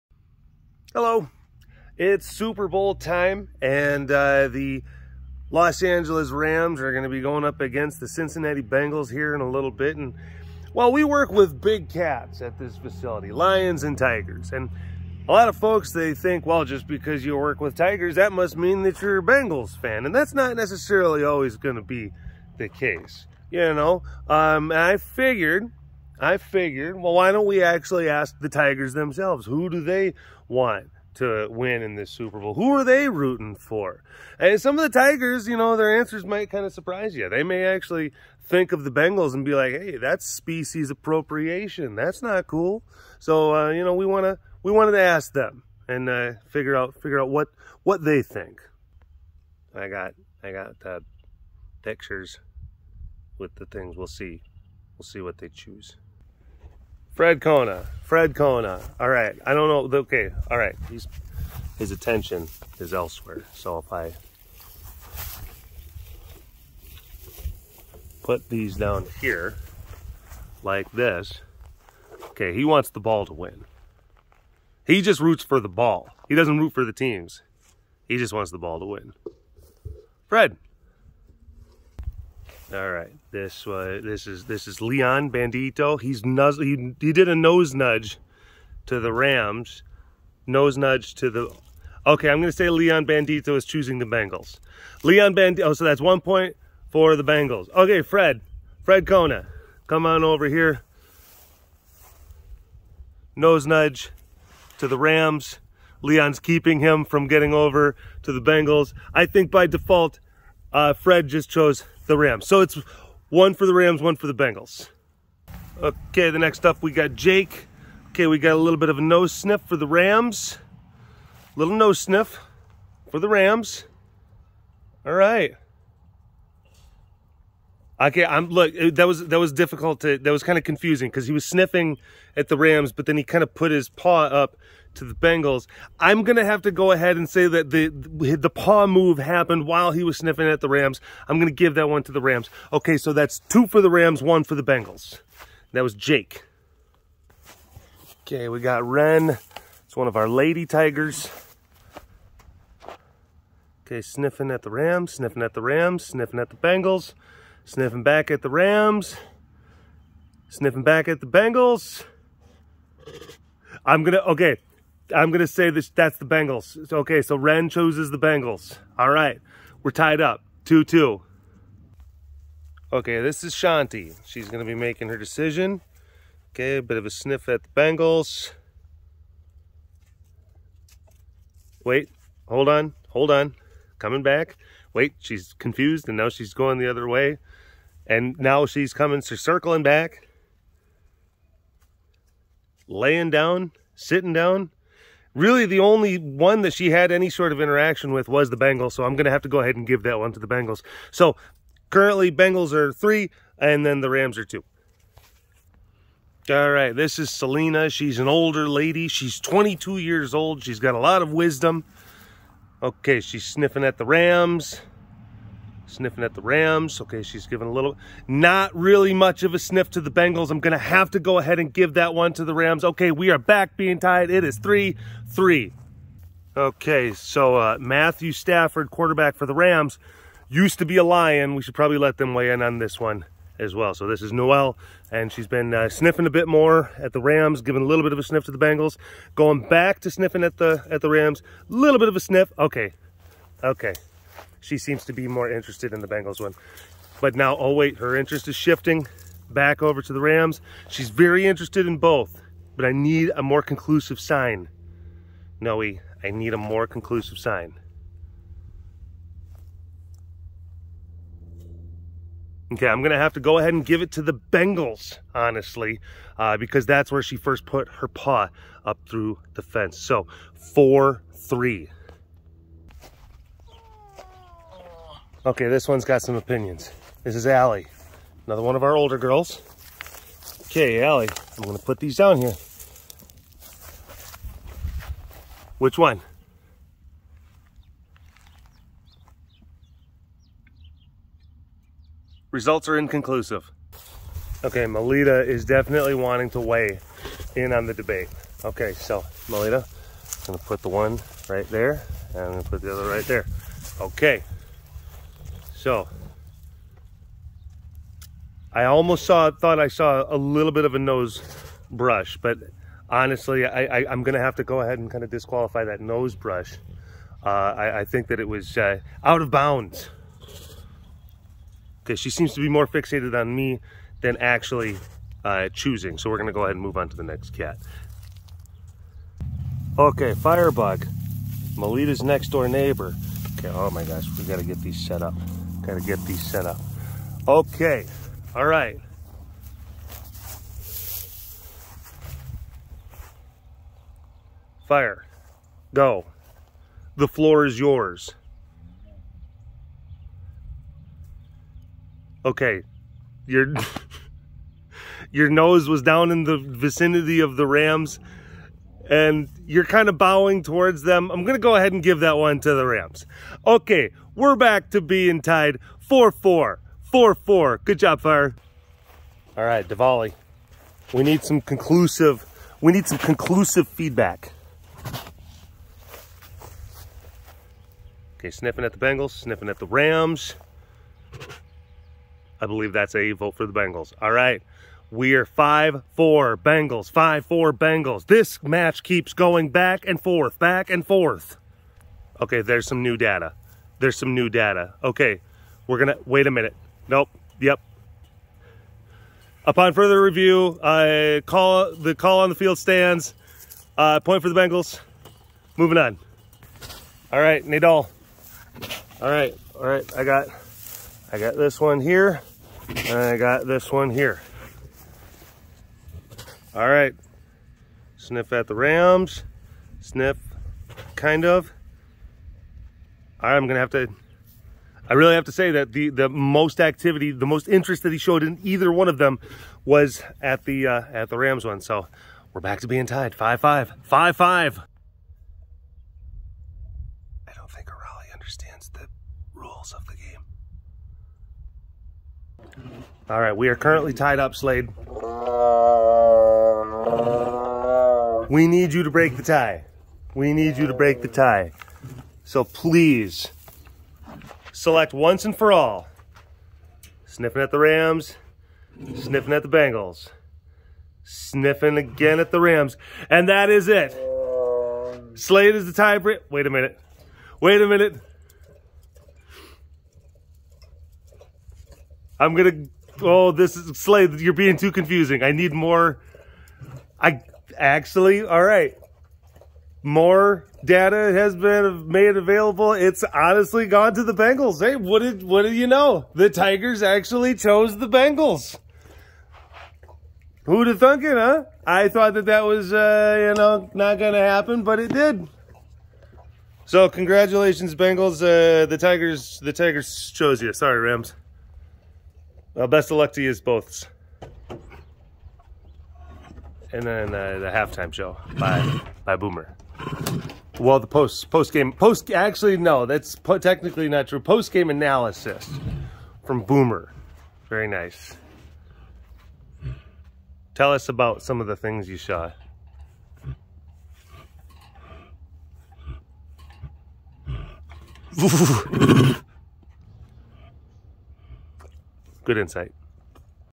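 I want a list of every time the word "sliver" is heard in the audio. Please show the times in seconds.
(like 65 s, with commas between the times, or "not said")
not said.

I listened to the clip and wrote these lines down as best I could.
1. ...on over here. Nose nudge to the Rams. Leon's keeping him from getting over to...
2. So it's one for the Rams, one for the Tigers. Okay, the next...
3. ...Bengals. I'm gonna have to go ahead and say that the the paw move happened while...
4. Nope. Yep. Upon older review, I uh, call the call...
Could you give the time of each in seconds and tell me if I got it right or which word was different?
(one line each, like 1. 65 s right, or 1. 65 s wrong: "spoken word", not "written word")
1. 100 s right
2. 112 s wrong: "Bengals", not "Tigers"
3. 135 s right
4. 397 s wrong: "further", not "older".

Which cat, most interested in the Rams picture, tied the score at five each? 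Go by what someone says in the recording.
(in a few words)
Nadal.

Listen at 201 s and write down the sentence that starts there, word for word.
So, currently, Bengals are three, and then the Rams are two.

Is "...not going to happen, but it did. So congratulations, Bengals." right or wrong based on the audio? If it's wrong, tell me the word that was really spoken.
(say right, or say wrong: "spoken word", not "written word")
right.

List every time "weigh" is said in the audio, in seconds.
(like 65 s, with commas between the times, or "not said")
232 s, 296 s.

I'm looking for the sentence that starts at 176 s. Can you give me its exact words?
Okay, a bit of a sniff at the Bengals.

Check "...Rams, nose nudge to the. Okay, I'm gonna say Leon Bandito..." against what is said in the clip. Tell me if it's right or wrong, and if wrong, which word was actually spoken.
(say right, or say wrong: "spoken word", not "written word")
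right.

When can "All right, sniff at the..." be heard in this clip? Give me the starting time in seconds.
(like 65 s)
416 s.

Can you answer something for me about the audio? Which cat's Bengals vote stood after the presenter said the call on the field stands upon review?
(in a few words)
Diwali.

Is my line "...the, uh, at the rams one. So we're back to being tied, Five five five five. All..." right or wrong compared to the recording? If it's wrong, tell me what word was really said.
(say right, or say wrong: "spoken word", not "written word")
right.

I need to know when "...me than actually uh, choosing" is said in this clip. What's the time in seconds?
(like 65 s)
323 s.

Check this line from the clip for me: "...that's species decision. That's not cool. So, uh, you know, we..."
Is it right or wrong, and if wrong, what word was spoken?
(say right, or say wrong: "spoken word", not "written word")
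wrong: "appropriation", not "decision".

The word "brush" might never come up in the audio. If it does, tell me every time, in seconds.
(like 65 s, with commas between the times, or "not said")
311 s, 316 s.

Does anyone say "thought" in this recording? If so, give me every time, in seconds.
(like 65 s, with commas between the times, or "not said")
309 s, 492 s.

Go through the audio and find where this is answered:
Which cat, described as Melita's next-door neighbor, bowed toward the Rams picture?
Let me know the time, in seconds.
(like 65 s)
330 s.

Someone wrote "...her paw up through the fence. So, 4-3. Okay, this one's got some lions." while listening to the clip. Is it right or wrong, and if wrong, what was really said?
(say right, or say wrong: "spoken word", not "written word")
wrong: "opinions", not "lions".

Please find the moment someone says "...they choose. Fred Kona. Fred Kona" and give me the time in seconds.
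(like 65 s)
55 s.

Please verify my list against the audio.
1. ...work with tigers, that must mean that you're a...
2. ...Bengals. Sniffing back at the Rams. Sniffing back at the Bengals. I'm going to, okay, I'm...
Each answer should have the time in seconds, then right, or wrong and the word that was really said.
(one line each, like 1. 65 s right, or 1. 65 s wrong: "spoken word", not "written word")
1. 17 s right
2. 156 s right.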